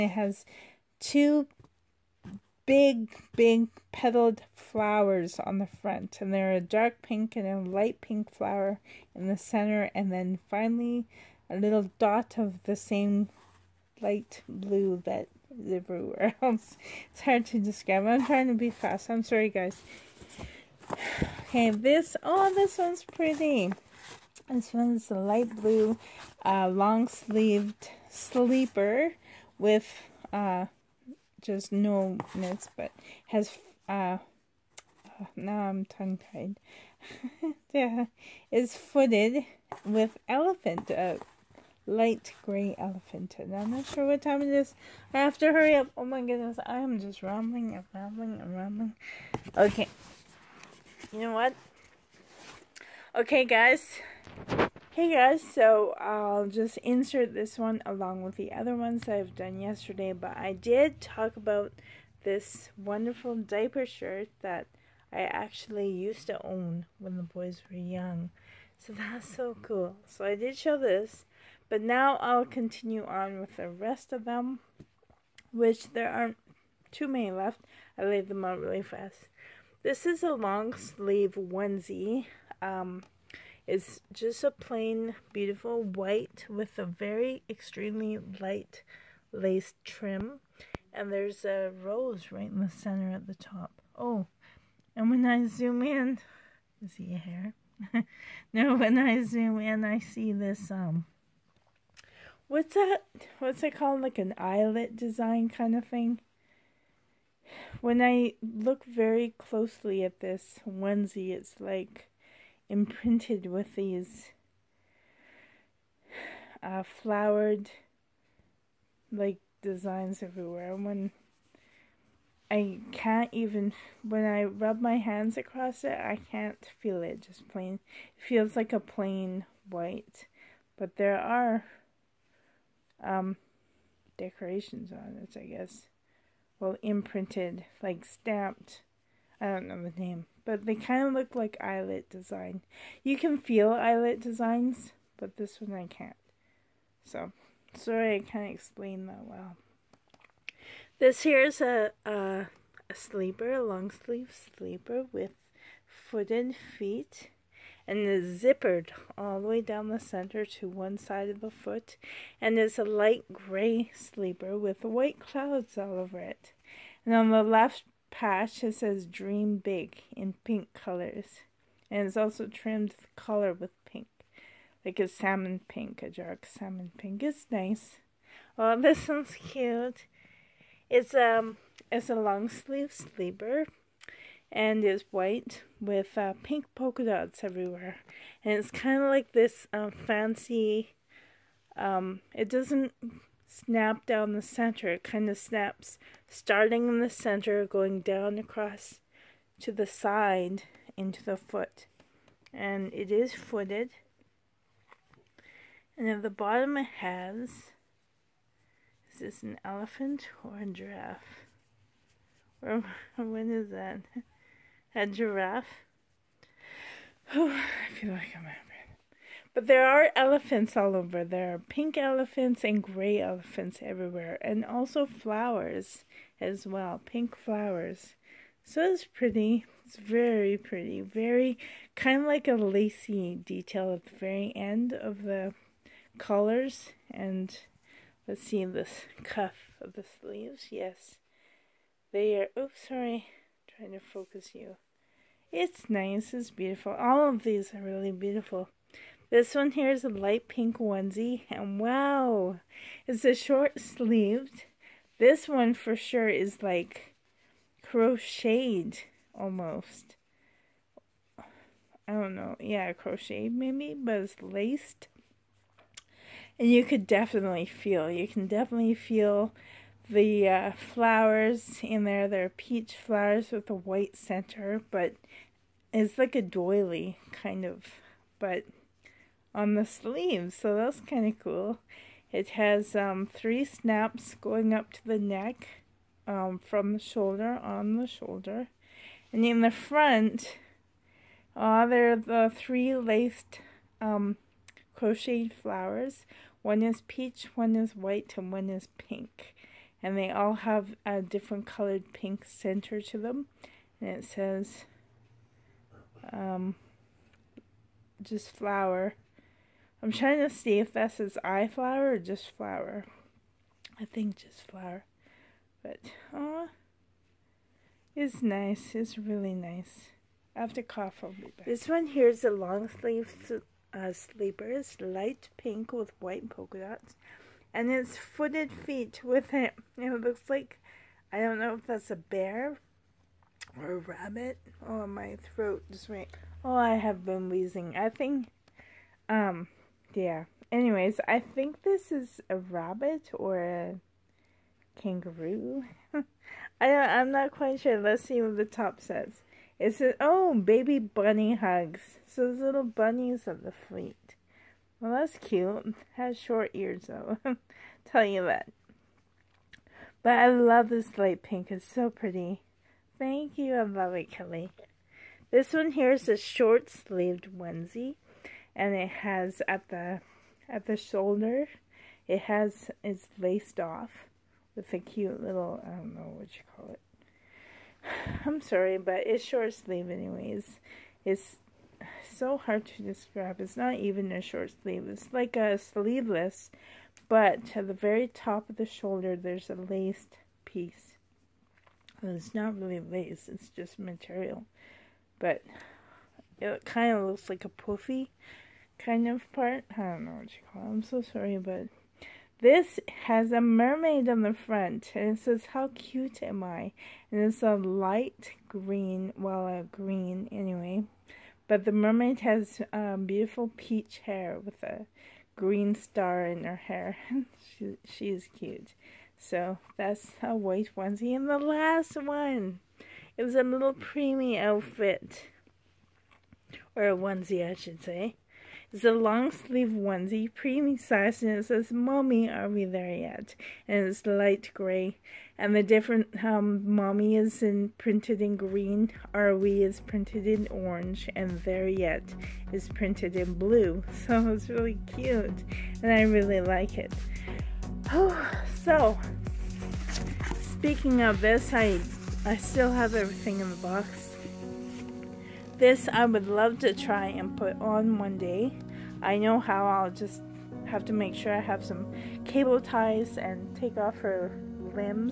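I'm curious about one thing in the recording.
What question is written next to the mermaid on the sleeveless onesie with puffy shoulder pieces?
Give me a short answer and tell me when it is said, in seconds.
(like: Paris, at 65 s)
How cute am I?, at 405 s.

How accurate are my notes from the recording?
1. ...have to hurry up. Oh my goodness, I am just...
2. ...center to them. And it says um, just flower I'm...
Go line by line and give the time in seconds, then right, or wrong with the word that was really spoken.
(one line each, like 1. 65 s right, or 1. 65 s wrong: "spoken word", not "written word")
1. 45 s right
2. 302 s right.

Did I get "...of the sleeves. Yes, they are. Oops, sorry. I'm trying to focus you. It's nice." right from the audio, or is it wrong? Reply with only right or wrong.
right.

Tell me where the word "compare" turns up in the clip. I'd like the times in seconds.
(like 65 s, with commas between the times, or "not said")
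not said.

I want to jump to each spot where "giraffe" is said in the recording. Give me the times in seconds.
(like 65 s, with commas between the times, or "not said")
210 s, 215 s.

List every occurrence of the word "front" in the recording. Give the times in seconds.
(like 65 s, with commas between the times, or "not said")
5 s, 289 s, 404 s.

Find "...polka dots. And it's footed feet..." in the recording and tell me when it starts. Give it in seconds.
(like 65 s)
326 s.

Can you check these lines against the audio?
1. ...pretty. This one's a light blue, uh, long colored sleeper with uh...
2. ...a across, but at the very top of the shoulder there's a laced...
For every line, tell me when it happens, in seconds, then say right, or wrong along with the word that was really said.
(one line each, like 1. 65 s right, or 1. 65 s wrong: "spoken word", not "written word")
1. 23 s wrong: "sleeved", not "colored"
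2. 385 s wrong: "sleeveless", not "across".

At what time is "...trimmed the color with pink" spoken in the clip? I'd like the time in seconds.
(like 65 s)
172 s.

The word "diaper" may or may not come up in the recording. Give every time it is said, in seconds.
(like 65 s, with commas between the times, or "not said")
63 s.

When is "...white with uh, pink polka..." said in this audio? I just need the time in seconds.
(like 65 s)
185 s.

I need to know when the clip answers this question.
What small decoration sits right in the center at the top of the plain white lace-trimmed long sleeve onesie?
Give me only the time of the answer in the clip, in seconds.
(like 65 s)
91 s.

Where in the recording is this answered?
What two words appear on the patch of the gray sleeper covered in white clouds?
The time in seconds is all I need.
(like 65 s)
169 s.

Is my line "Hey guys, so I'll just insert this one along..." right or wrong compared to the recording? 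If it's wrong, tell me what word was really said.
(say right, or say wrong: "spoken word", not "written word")
right.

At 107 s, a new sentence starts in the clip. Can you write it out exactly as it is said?
When I look very closely at this onesie, it's like imprinted with these uh, flowered like designs everywhere.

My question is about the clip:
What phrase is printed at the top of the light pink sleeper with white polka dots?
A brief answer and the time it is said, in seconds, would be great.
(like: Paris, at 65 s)
Oh, baby bunny hugs, at 350 s.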